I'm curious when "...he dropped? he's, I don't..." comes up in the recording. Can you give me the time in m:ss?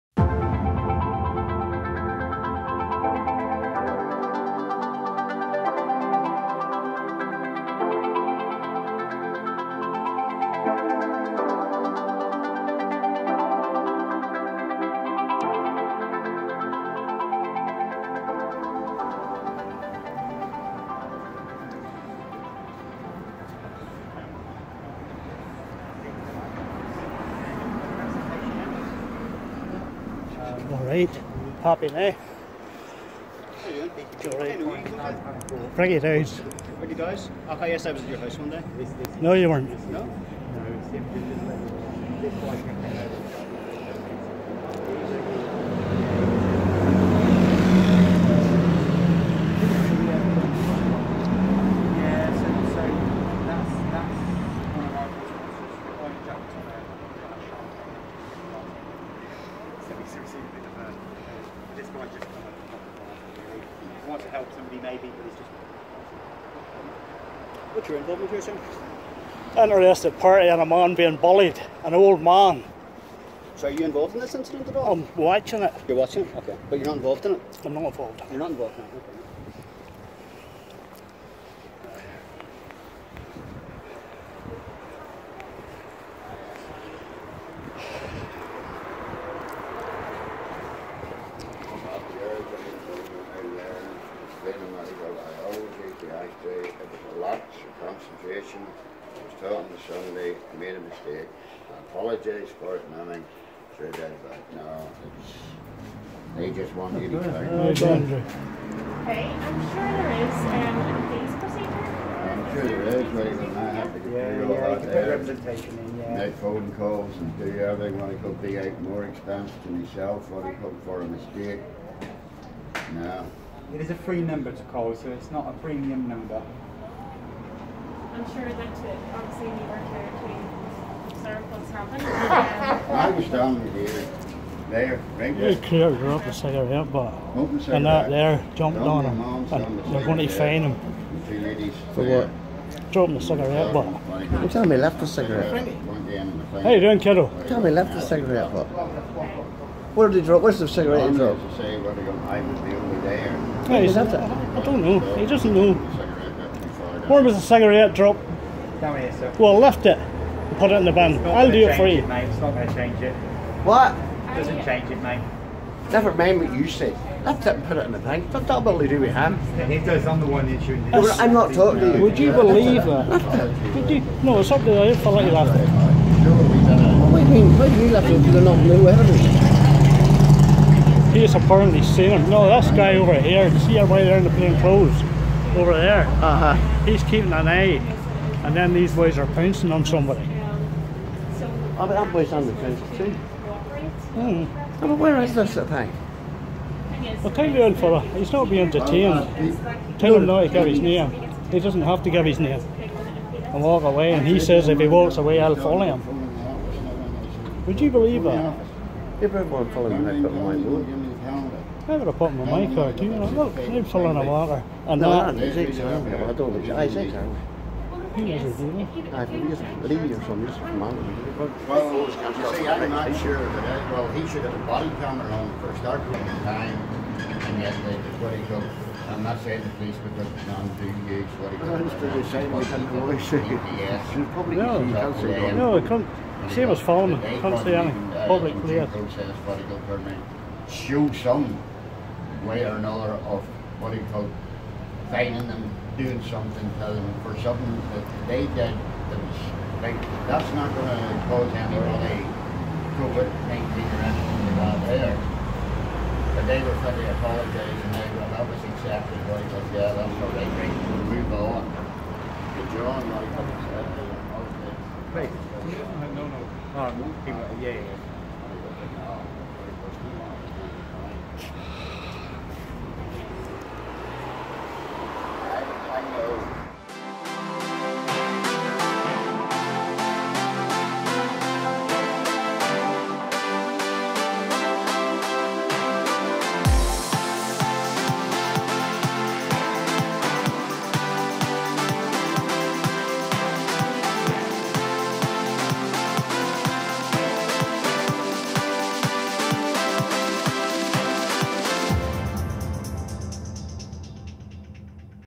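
2:31.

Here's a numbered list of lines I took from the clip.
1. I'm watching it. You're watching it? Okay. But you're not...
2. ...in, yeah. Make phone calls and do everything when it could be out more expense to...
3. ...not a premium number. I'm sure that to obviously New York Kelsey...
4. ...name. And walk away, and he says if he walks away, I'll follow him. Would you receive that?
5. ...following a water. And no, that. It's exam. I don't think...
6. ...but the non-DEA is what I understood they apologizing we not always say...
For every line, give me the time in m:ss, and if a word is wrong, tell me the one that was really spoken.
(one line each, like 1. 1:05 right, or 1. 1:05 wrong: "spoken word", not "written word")
1. 1:14 right
2. 1:55 right
3. 2:05 wrong: "Territory", not "Kelsey"
4. 3:22 wrong: "believe", not "receive"
5. 3:33 right
6. 3:50 wrong: "saying", not "apologizing".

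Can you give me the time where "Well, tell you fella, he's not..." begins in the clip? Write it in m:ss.
3:17.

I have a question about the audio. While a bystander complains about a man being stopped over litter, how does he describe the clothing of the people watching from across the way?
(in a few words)
plain clothes.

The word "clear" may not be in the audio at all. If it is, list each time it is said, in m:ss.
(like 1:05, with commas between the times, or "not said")
2:15, 3:58.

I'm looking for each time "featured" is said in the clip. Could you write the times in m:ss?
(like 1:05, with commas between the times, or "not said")
not said.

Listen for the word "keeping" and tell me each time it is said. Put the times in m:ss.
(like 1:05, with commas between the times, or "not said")
3:07.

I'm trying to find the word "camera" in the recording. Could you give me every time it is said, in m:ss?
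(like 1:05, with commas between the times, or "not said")
3:44.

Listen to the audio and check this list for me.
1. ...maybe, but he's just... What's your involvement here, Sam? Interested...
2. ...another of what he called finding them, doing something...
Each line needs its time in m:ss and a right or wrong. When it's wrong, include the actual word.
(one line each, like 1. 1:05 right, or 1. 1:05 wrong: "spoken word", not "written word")
1. 1:04 right
2. 4:02 right.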